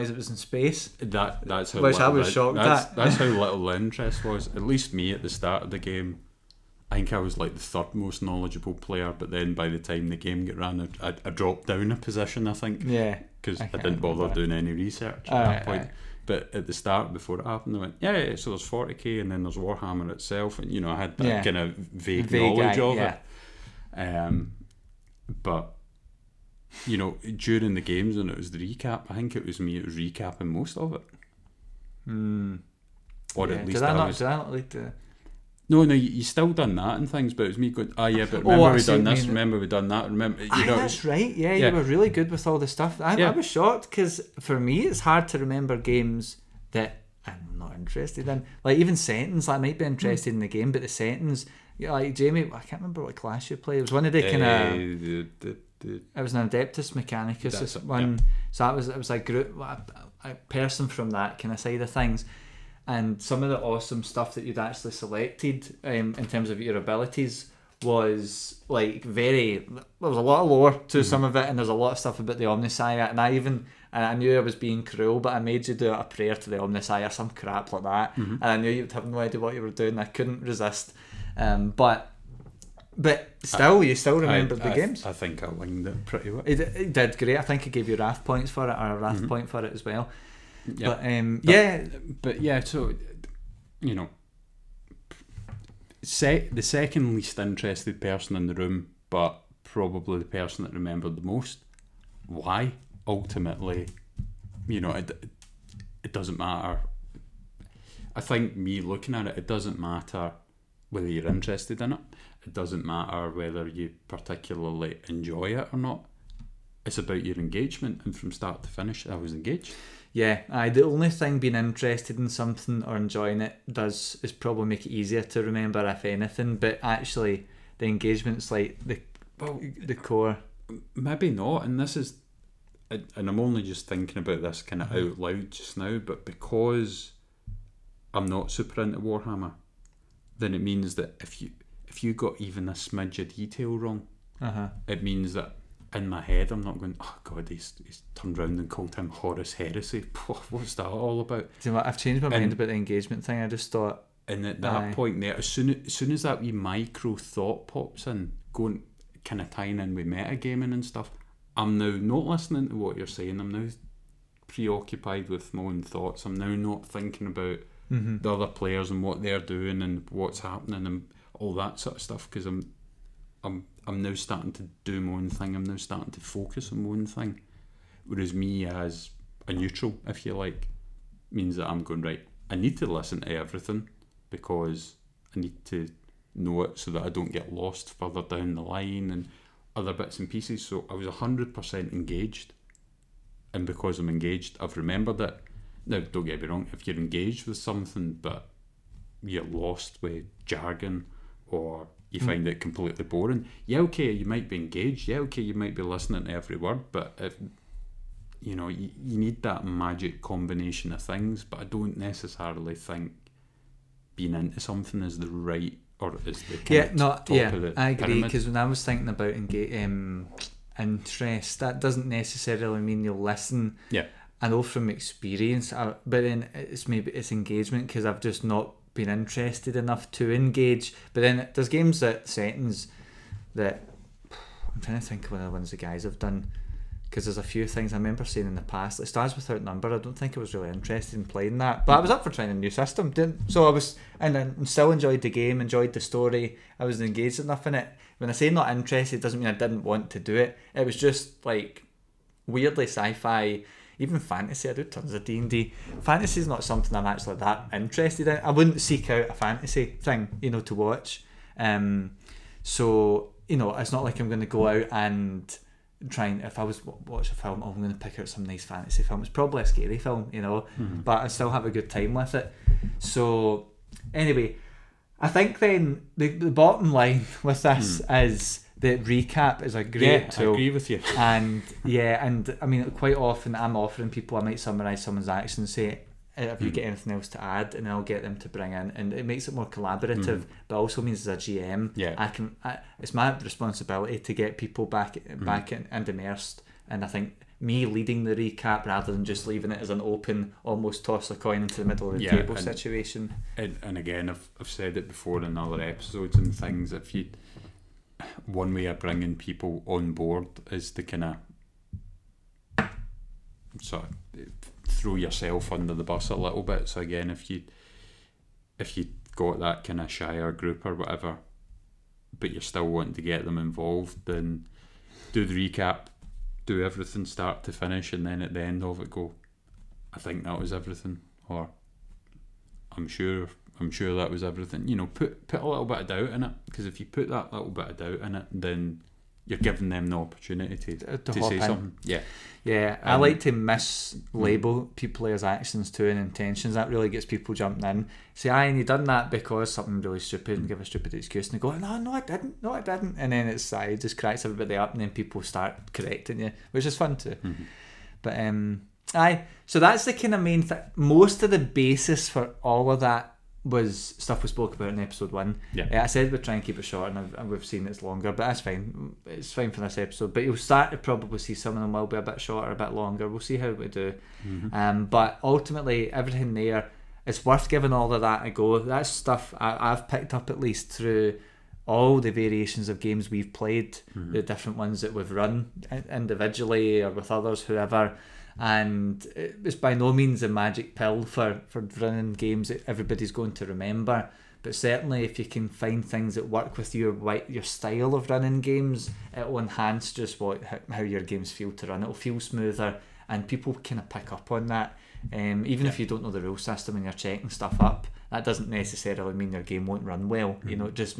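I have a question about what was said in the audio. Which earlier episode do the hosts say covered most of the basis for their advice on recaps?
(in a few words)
episode 1.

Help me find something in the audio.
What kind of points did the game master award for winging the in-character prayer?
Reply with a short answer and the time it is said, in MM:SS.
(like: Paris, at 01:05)
wrath points, at 01:27.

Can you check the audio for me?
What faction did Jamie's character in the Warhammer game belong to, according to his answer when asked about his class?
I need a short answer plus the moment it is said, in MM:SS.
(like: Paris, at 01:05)
Adeptus Mechanicus, at 00:56.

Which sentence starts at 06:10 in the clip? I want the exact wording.
But you'll start to probably see some of them will be a bit shorter, a bit longer.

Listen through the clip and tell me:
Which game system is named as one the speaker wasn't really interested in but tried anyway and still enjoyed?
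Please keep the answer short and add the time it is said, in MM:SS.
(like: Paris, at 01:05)
Stars Without Number, at 03:59.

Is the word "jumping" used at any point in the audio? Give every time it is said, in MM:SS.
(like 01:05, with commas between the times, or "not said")
05:47.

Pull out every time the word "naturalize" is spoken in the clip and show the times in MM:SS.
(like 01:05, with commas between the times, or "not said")
not said.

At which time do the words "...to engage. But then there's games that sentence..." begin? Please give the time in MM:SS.
03:50.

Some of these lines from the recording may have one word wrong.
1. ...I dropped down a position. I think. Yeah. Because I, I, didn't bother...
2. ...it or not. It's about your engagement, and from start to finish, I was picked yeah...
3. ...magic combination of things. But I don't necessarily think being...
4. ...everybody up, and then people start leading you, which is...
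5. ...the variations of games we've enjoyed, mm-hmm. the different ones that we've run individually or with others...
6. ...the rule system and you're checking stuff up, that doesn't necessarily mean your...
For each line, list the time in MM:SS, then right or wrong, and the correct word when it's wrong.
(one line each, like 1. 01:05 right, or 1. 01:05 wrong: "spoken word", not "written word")
1. 00:11 right
2. 01:55 wrong: "engaged", not "picked"
3. 03:29 right
4. 05:54 wrong: "correcting", not "leading"
5. 06:22 wrong: "played", not "enjoyed"
6. 06:46 right.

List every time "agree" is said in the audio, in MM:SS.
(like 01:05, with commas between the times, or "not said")
03:37, 04:40.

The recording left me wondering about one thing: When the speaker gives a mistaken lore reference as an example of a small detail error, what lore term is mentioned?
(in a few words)
Horus Heresy.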